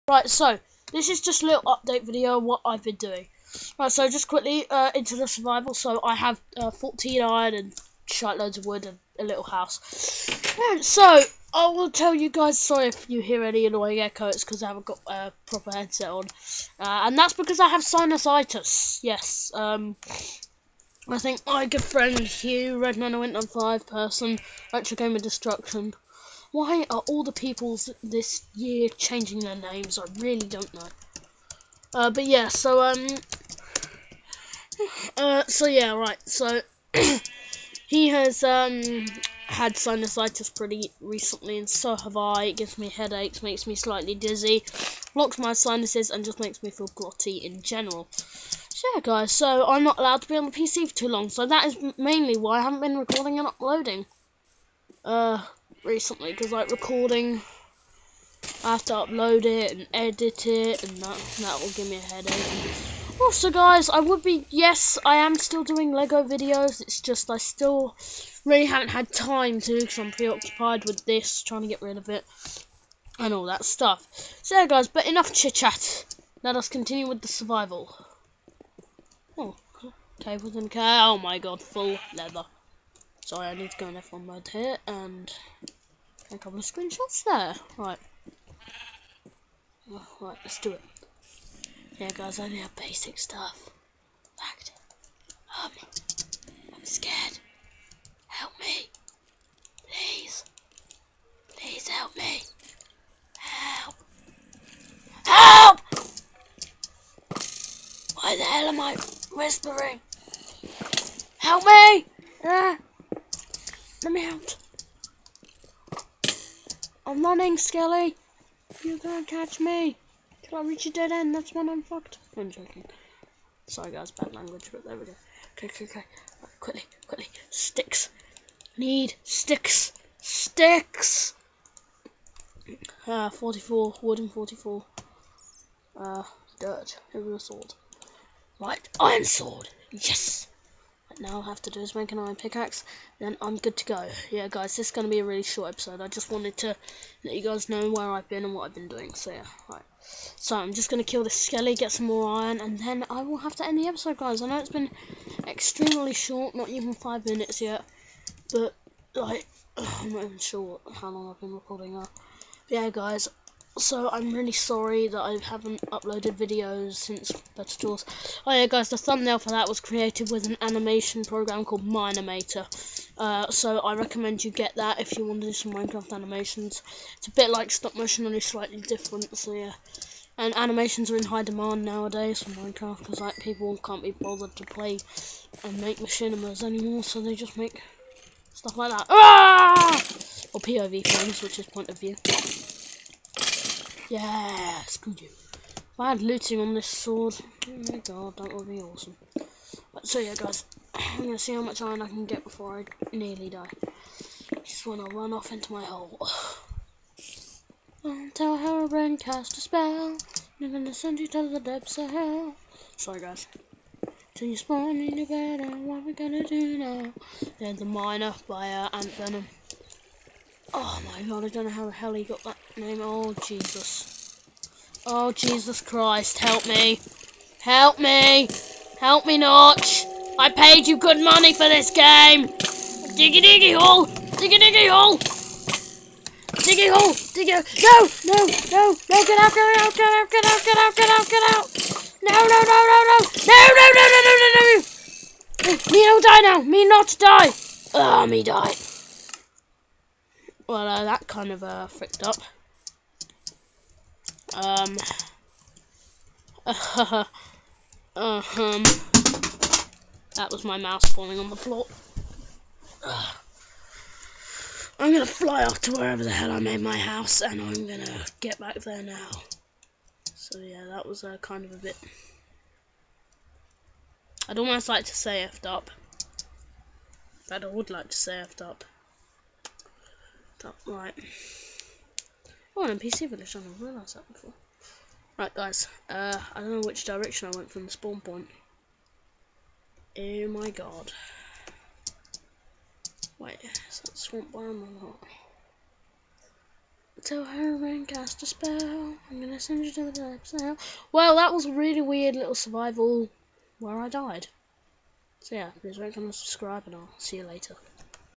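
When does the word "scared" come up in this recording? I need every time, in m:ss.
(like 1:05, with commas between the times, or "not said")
1:36.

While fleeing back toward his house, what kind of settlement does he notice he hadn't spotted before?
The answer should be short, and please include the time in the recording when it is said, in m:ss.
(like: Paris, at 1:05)
NPC village, at 4:42.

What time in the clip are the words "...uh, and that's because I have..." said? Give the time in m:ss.
0:16.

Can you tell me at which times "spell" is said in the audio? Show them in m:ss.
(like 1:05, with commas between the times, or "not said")
3:29, 4:58.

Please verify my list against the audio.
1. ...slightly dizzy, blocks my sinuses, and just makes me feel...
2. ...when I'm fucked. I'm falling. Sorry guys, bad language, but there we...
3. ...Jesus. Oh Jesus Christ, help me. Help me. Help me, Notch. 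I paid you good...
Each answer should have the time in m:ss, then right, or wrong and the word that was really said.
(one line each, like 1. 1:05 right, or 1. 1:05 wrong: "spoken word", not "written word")
1. 0:43 right
2. 2:01 wrong: "joking", not "falling"
3. 3:43 right.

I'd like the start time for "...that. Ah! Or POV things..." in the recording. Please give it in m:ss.
3:08.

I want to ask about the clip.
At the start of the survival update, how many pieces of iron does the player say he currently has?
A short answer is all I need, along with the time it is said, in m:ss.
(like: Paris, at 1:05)
14, at 0:06.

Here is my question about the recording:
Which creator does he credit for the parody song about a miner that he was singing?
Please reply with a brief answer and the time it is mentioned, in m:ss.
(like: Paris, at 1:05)
Ant Venom, at 3:38.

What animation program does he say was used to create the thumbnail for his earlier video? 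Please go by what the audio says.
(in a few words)
Mine-imator.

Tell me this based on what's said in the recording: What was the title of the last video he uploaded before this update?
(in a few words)
Better Tools.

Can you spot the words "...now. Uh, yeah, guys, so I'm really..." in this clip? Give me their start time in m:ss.
2:41.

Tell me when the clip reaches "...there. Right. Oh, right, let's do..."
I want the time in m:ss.
1:27.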